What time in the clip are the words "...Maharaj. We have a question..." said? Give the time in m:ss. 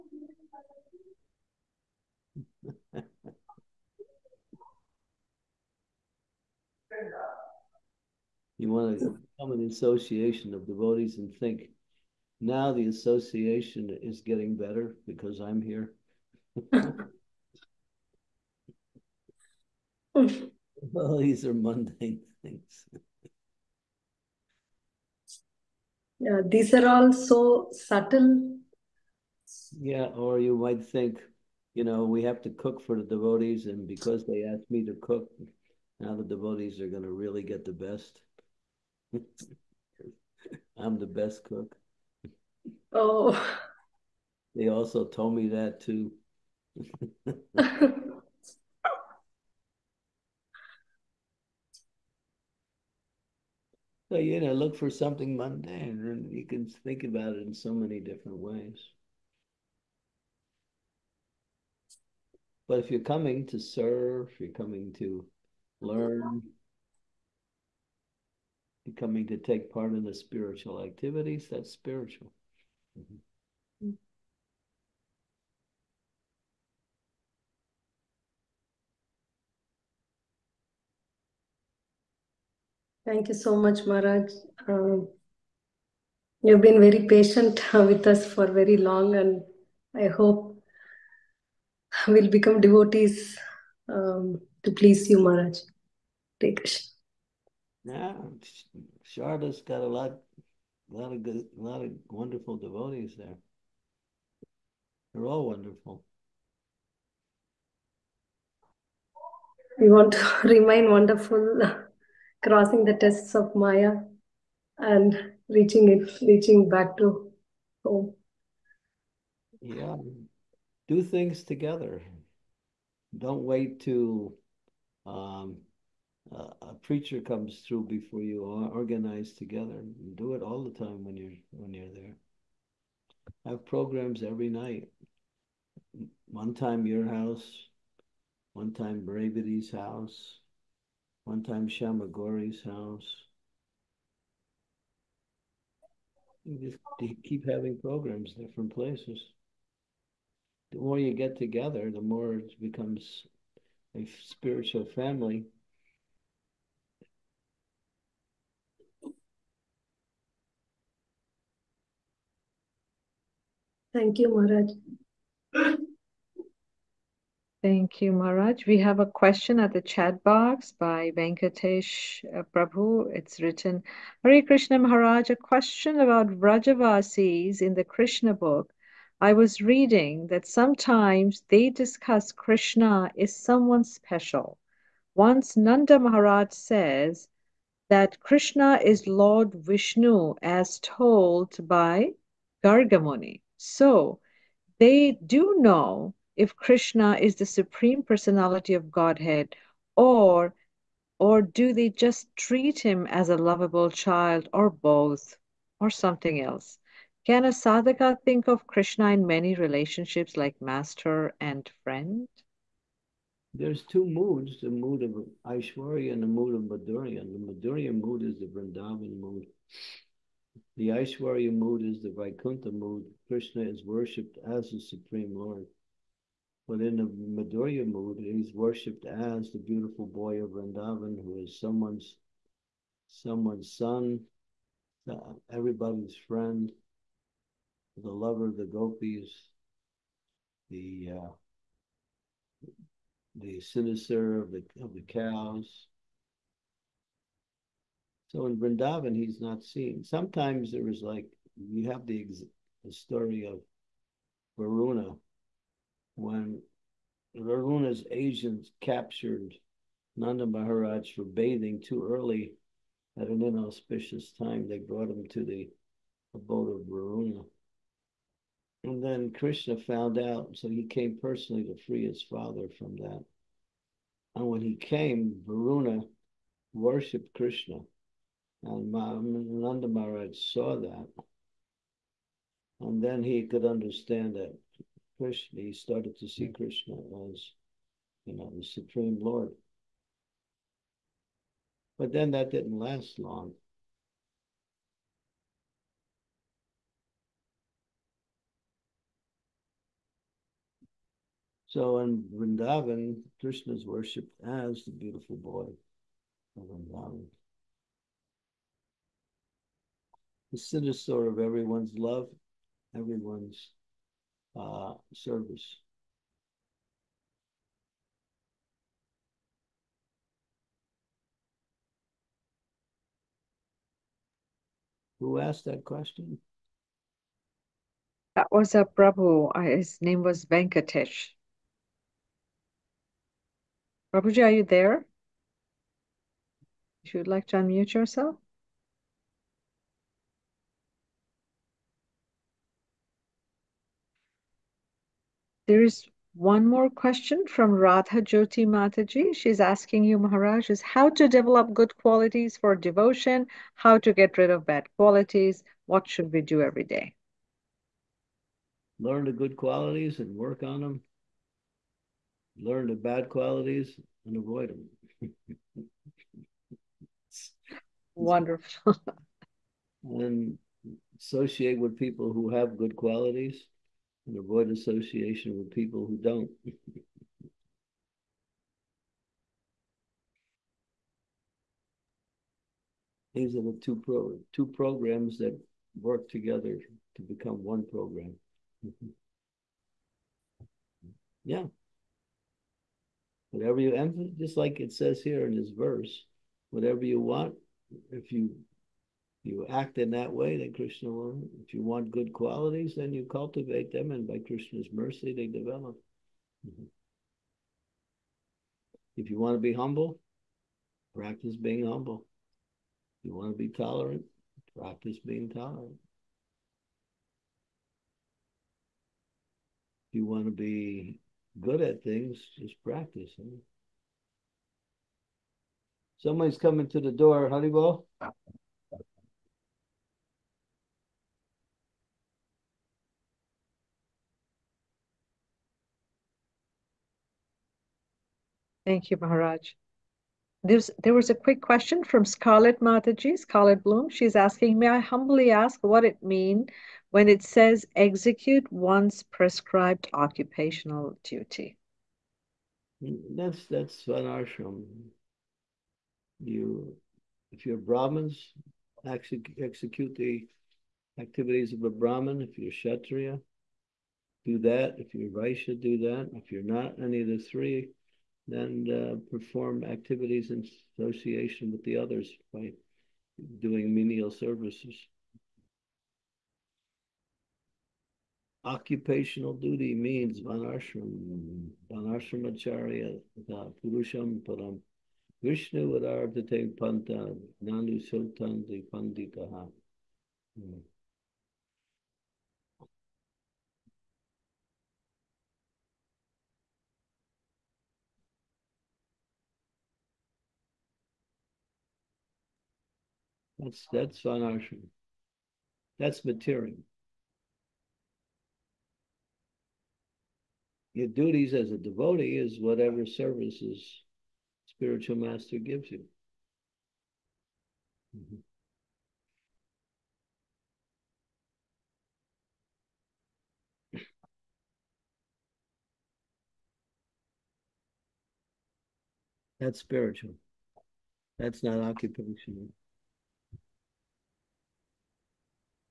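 2:48.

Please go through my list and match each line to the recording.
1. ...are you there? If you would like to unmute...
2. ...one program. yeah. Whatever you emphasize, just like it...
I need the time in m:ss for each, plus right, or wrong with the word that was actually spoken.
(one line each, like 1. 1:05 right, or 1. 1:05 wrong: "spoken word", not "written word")
1. 5:34 right
2. 6:27 right.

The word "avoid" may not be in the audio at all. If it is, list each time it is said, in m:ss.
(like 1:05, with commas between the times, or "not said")
6:04, 6:14.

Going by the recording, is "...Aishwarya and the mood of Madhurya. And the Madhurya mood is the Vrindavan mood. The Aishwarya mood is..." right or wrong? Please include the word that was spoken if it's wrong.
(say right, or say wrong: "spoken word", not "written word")
right.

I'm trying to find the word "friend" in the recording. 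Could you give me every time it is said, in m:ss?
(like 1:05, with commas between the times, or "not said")
3:31, 3:56.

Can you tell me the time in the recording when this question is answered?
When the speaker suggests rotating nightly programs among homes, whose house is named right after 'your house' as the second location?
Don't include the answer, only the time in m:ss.
2:19.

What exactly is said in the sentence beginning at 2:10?
Do it all the time when you're when you're there.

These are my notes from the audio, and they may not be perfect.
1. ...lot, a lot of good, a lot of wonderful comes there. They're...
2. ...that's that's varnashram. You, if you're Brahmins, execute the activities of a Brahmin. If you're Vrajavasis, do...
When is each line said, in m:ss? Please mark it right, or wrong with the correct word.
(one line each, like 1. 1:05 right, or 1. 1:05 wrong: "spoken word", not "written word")
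1. 1:39 wrong: "devotees", not "comes"
2. 7:33 wrong: "Kshatriya", not "Vrajavasis".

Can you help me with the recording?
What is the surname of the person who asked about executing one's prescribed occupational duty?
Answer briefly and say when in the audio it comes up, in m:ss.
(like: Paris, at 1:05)
Bloom, at 7:23.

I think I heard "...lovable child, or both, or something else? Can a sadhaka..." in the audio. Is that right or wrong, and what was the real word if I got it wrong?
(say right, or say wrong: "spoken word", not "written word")
right.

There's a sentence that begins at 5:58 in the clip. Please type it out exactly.
Learn the good qualities and work on them.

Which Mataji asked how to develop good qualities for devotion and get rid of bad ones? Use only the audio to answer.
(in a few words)
Radha Jyoti.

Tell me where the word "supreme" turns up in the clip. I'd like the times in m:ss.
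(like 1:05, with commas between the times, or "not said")
3:17, 3:44, 4:48.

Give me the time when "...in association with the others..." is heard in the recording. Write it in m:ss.
7:50.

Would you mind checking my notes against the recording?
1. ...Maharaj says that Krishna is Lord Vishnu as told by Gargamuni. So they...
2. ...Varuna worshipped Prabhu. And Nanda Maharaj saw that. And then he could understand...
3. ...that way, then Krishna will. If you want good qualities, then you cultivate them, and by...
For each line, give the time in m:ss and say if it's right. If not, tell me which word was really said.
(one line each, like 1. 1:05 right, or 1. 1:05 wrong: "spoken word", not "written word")
1. 3:05 right
2. 4:35 wrong: "Krishna", not "Prabhu"
3. 6:40 right.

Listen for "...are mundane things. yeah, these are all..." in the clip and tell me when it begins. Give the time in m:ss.
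0:21.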